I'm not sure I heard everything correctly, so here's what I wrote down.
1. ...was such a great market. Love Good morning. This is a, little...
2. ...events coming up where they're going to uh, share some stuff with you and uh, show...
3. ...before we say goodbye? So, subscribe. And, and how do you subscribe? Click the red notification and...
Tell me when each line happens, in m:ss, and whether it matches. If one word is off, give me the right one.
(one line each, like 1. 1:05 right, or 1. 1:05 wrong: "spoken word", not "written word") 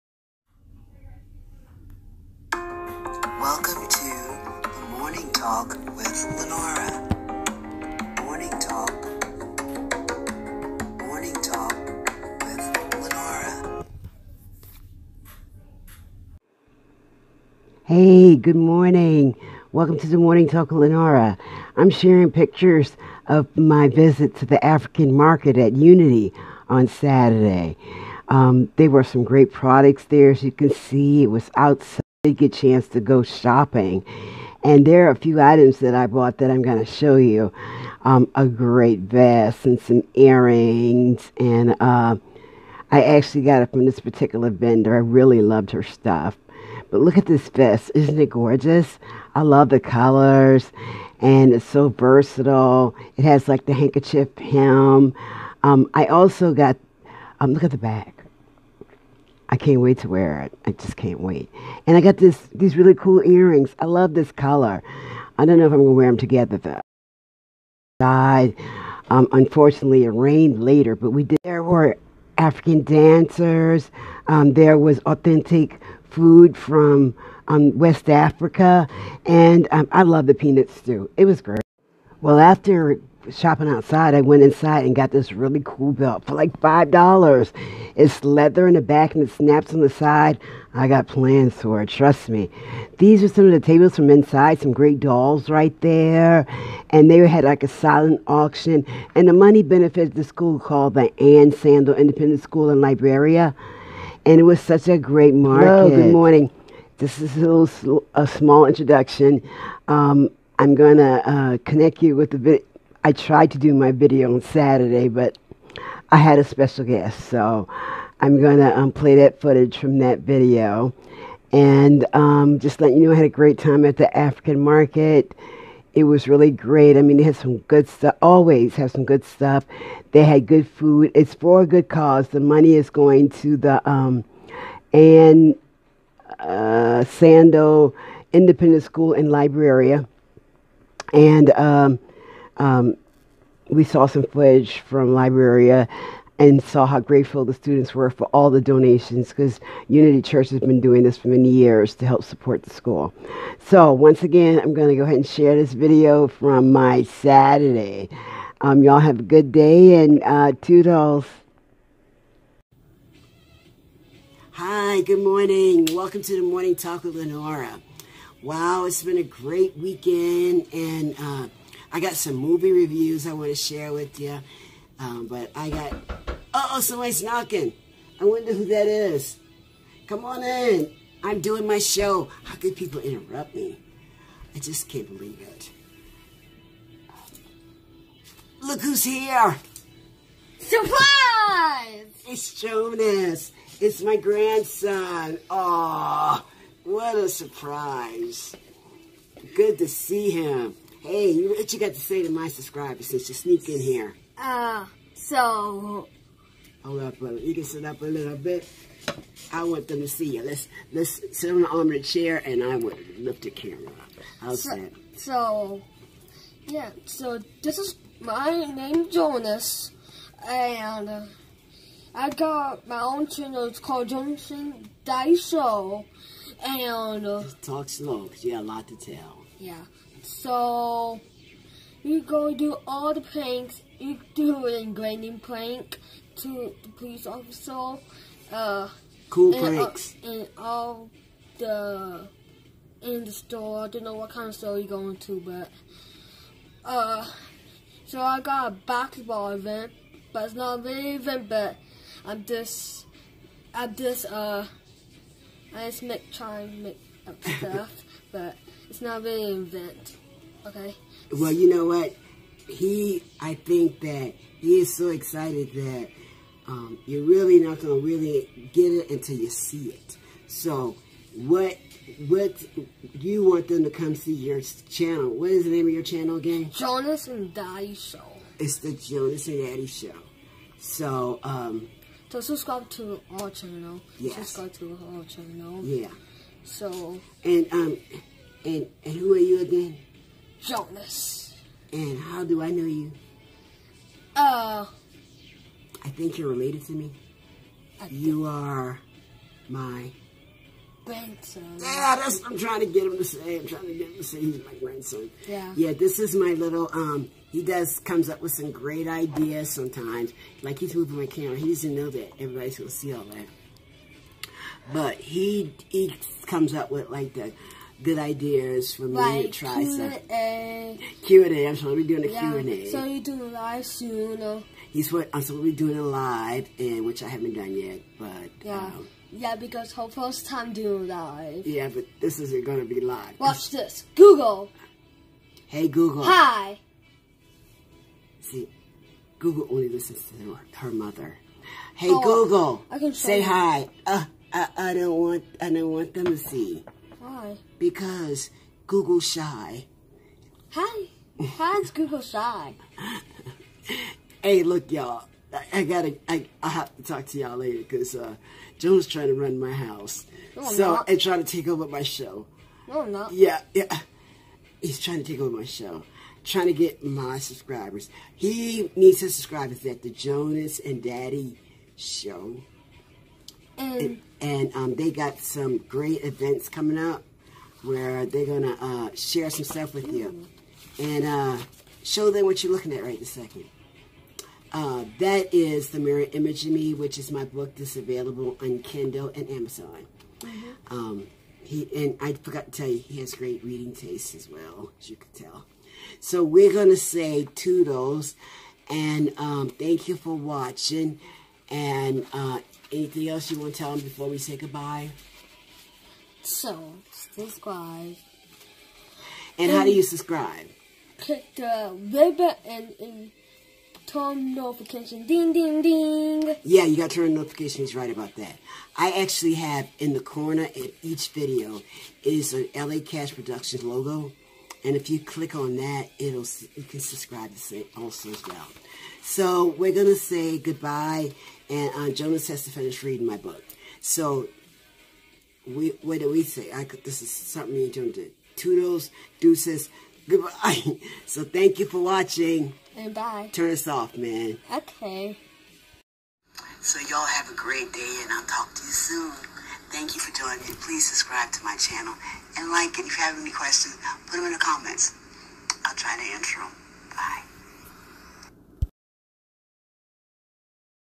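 1. 1:44 right
2. 6:16 right
3. 6:44 wrong: "button", not "notification".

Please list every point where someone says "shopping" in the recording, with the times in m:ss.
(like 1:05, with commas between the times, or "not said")
0:33, 1:23.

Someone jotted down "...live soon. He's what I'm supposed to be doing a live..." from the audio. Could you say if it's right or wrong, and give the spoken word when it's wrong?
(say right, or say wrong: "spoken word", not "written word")
right.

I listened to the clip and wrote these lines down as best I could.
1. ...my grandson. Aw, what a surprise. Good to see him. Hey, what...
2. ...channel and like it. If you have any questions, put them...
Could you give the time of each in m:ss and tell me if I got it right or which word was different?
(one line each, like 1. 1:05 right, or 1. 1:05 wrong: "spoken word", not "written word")
1. 3:14 right
2. 7:31 right.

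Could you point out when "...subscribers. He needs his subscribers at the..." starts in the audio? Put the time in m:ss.
6:07.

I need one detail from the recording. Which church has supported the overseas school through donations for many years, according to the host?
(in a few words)
Unity Church.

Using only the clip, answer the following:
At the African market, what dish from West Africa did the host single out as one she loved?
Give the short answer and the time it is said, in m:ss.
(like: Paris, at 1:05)
Peanut stew, at 1:20.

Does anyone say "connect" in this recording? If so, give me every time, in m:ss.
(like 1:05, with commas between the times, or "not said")
1:51.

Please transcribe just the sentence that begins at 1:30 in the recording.
I got plans for it, trust me.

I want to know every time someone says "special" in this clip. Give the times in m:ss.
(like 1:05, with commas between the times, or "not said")
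1:56.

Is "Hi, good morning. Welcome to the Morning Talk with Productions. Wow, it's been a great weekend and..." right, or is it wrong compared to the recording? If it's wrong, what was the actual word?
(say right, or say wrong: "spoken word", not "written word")
wrong: "Lenora", not "Productions".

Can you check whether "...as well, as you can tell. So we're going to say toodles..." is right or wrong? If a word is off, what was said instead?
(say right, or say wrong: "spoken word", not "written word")
right.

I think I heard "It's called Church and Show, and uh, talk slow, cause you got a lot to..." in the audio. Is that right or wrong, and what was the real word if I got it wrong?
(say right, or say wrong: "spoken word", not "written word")
wrong: "Jonas", not "Church".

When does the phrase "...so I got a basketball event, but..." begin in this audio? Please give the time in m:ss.
4:08.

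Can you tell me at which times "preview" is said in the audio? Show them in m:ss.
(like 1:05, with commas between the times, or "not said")
not said.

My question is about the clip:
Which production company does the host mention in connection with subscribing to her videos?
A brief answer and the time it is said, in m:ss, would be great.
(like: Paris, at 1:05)
LA Cash Productions, at 7:02.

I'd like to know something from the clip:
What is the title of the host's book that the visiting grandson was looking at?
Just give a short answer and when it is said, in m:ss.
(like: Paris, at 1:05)
The Mirror Image of Me, at 6:25.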